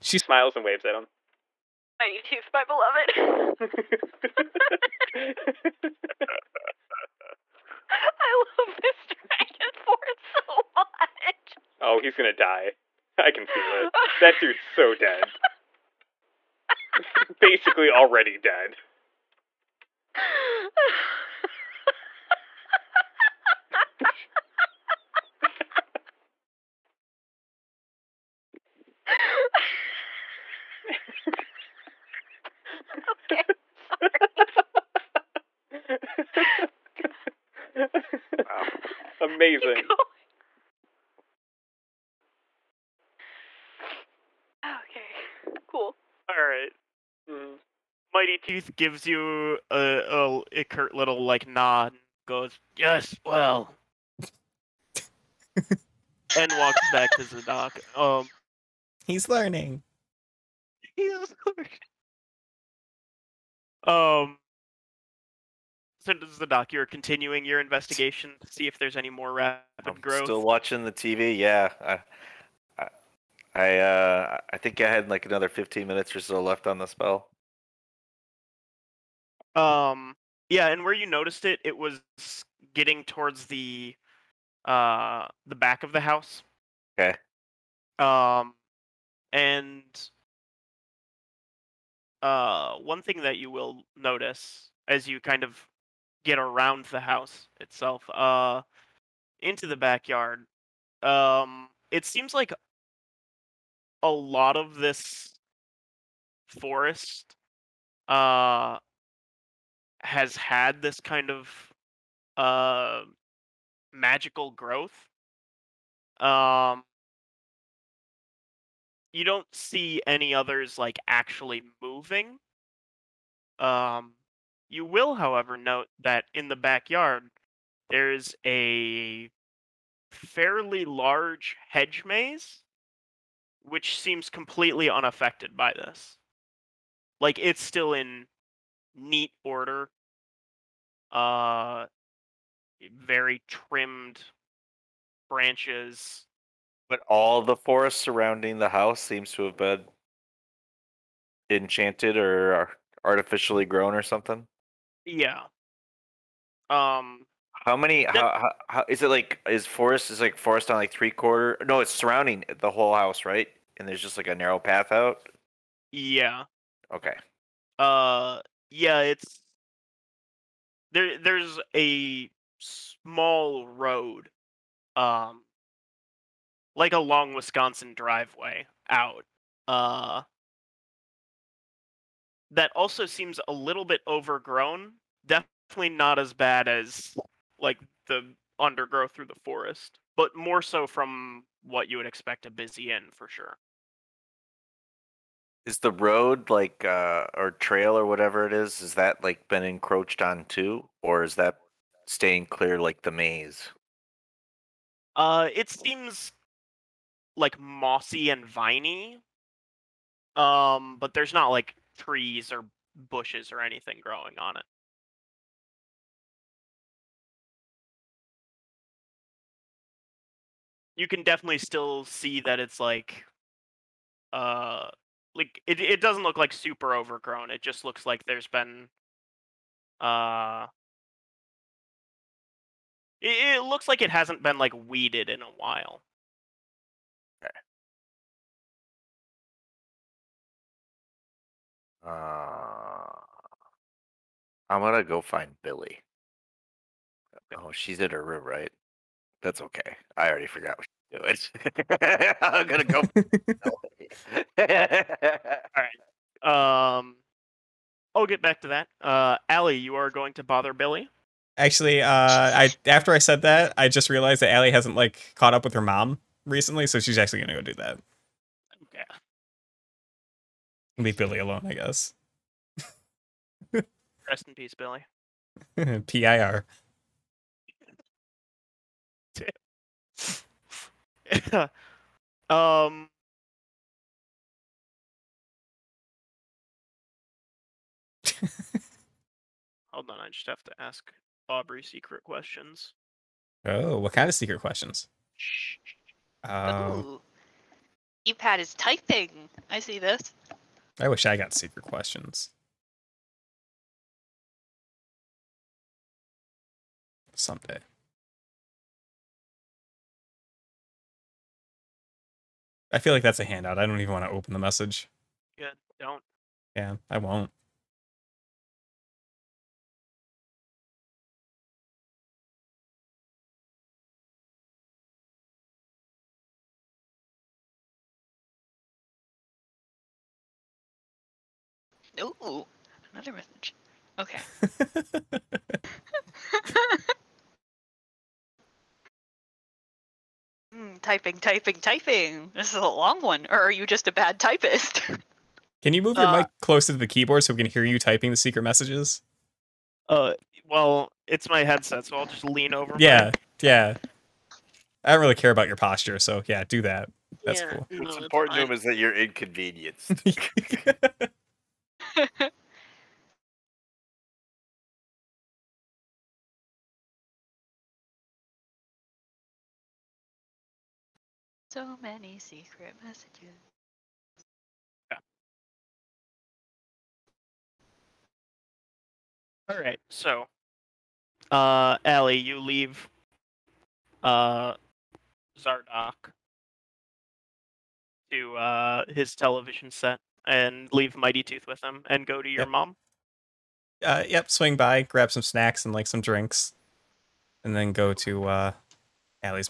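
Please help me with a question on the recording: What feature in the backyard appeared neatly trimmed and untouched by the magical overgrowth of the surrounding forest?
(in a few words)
hedge maze.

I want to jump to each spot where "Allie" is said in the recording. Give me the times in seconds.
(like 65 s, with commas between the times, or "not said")
259 s, 264 s.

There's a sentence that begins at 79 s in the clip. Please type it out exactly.
Um, yeah, and where you noticed it, it was getting towards the uh the back of the house.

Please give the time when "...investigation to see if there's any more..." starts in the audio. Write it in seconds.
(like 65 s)
67 s.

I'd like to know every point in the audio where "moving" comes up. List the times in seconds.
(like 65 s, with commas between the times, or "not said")
121 s.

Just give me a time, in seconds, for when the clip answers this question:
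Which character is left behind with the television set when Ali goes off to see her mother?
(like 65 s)
385 s.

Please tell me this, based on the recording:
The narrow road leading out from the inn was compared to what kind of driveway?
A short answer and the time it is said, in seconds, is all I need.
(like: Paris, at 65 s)
Wisconsin driveway, at 177 s.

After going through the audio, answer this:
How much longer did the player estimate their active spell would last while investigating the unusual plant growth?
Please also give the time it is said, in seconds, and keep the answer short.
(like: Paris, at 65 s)
15 minutes, at 75 s.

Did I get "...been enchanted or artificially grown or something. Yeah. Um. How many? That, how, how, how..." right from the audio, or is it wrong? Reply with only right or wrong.
right.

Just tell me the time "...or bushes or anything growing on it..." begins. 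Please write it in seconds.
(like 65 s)
212 s.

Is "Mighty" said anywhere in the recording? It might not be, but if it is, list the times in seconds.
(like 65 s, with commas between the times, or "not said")
1 s, 48 s, 391 s.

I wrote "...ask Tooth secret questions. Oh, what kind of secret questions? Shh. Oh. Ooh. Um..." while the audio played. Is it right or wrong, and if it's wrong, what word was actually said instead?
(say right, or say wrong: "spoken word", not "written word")
wrong: "Aubrey", not "Tooth".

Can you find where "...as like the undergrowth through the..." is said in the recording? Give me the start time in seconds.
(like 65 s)
186 s.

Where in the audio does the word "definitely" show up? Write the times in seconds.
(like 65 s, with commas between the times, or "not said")
185 s, 221 s.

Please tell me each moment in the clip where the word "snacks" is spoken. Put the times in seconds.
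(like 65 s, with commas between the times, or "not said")
395 s.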